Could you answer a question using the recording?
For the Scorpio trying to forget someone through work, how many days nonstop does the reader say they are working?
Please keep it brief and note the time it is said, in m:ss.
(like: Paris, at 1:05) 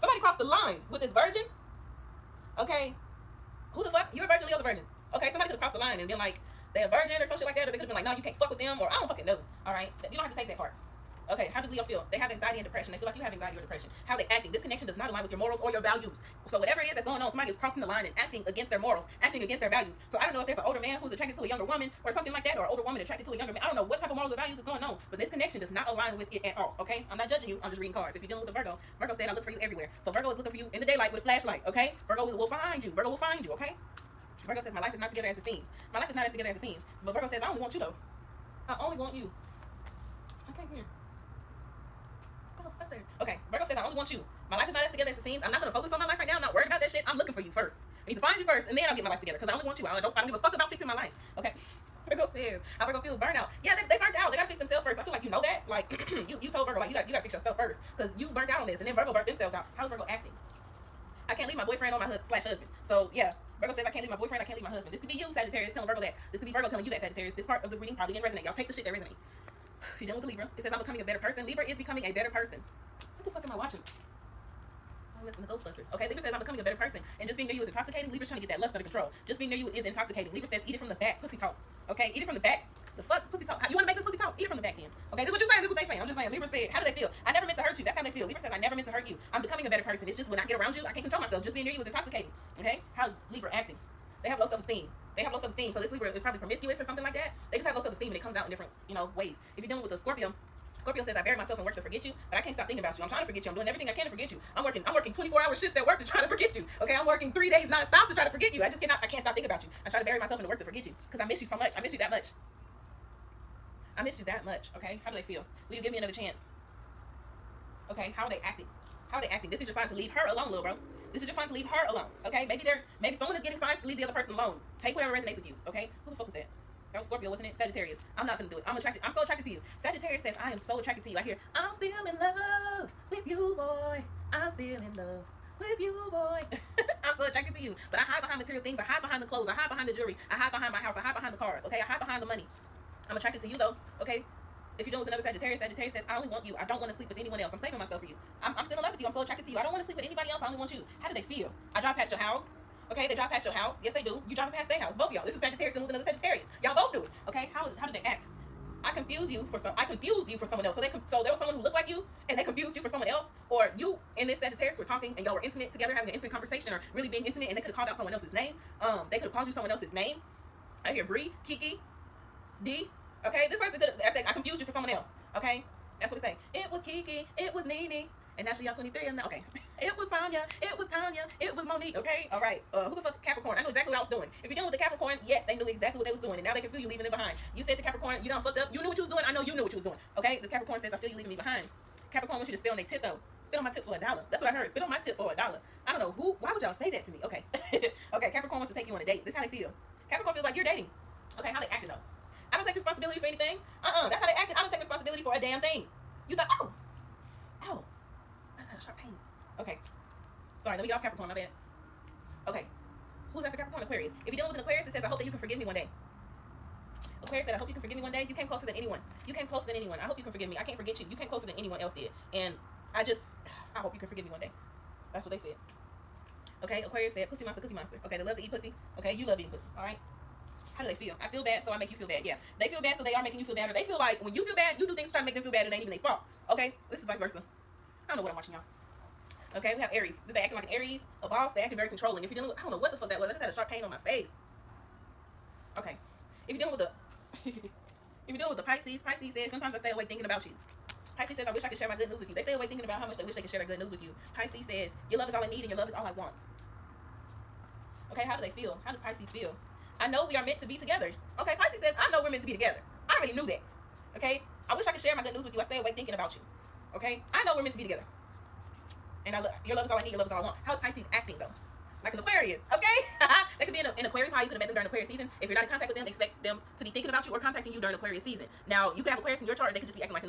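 3, at 1:47.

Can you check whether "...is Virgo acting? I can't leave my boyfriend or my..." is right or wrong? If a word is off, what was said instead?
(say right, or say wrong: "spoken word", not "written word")
right.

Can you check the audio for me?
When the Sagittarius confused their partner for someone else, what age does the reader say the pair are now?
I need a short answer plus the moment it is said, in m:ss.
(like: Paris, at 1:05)
23, at 2:58.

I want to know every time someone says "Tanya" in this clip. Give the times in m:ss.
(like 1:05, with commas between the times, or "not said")
3:00.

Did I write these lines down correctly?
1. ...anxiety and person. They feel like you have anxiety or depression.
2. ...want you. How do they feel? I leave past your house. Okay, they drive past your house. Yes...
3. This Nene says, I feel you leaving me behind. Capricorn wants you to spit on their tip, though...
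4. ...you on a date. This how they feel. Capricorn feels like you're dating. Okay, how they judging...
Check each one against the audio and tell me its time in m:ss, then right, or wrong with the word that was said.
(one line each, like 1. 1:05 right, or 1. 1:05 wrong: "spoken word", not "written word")
1. 0:12 wrong: "depression", not "person"
2. 2:30 wrong: "drive", not "leave"
3. 3:10 wrong: "Capricorn", not "Nene"
4. 3:18 wrong: "acting", not "judging".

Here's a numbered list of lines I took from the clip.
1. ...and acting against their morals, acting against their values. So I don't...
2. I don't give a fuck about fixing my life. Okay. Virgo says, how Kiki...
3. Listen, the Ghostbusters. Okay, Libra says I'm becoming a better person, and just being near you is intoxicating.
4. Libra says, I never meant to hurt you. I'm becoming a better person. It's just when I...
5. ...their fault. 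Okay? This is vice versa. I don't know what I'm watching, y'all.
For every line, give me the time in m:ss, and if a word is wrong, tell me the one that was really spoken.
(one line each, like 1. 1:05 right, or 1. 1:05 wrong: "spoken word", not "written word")
1. 0:18 right
2. 0:50 wrong: "Virgo", not "Kiki"
3. 1:15 right
4. 1:28 right
5. 3:55 right.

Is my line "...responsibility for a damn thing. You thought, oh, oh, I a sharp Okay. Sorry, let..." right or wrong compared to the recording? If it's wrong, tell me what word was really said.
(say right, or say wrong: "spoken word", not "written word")
right.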